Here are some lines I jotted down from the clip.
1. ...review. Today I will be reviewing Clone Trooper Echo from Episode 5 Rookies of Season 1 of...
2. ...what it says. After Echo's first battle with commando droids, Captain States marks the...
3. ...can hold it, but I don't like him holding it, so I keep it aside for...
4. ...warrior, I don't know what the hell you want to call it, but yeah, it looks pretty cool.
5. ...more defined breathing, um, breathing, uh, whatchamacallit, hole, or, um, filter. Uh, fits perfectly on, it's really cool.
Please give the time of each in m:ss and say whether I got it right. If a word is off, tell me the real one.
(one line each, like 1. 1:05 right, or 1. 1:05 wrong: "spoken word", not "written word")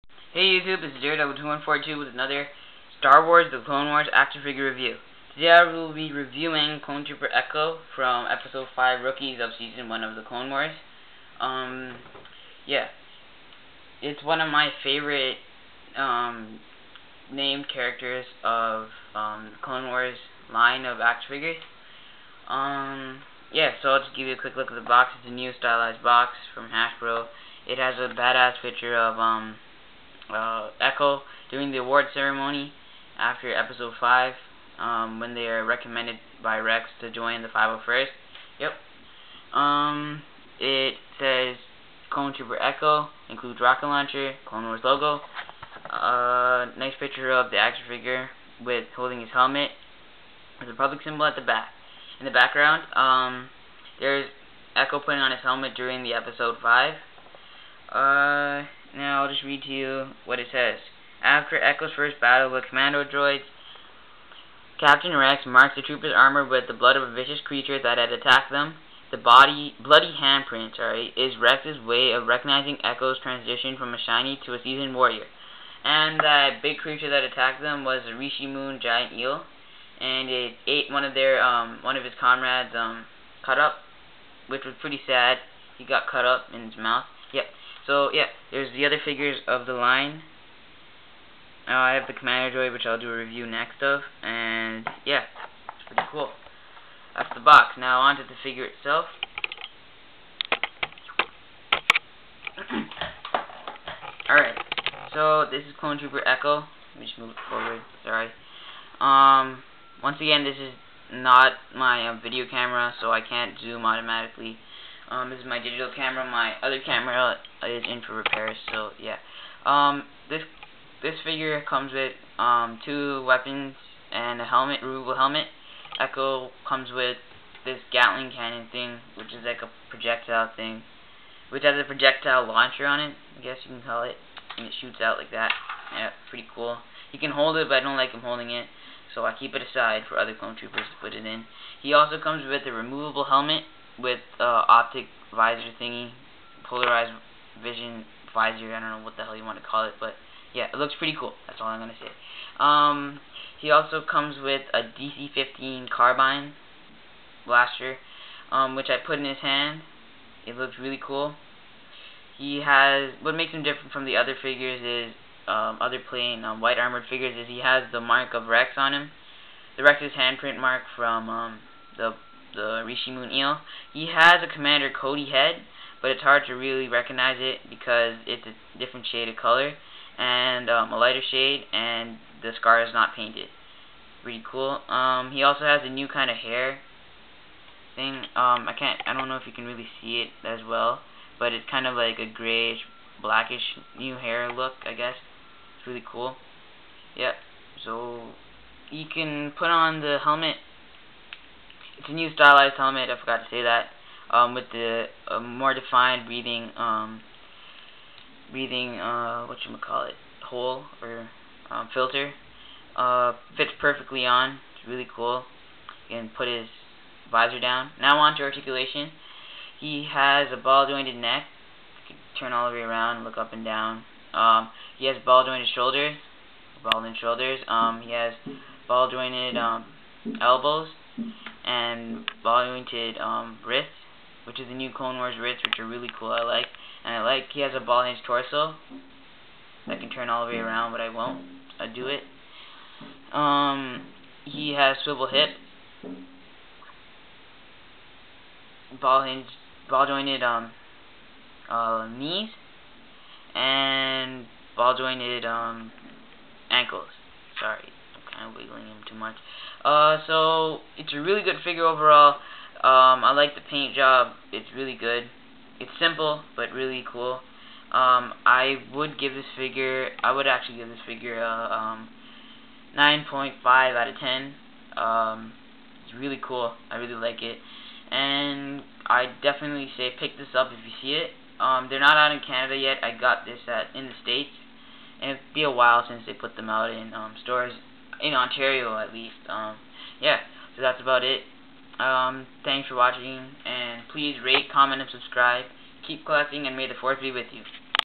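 1. 0:04 right
2. 1:00 wrong: "Rex", not "States"
3. 2:17 right
4. 2:28 wrong: "visor", not "warrior"
5. 3:25 right.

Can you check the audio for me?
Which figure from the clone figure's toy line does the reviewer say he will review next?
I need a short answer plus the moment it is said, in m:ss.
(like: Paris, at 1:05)
Commando Droid, at 1:32.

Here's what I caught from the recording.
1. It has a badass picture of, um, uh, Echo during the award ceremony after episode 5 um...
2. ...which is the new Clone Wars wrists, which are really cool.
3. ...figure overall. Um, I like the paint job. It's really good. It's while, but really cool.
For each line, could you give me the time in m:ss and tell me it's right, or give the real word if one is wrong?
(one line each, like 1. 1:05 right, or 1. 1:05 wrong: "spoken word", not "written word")
1. 0:27 right
2. 3:54 right
3. 4:21 wrong: "simple", not "while".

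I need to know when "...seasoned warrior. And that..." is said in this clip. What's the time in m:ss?
1:14.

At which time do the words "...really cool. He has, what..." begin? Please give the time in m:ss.
2:40.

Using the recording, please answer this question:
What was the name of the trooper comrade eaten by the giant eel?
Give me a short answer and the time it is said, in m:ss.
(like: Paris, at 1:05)
Cutup, at 1:23.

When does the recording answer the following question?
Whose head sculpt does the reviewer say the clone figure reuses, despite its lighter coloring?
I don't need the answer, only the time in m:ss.
2:54.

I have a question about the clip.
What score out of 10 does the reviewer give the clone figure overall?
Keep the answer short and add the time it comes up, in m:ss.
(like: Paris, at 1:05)
9.5, at 4:32.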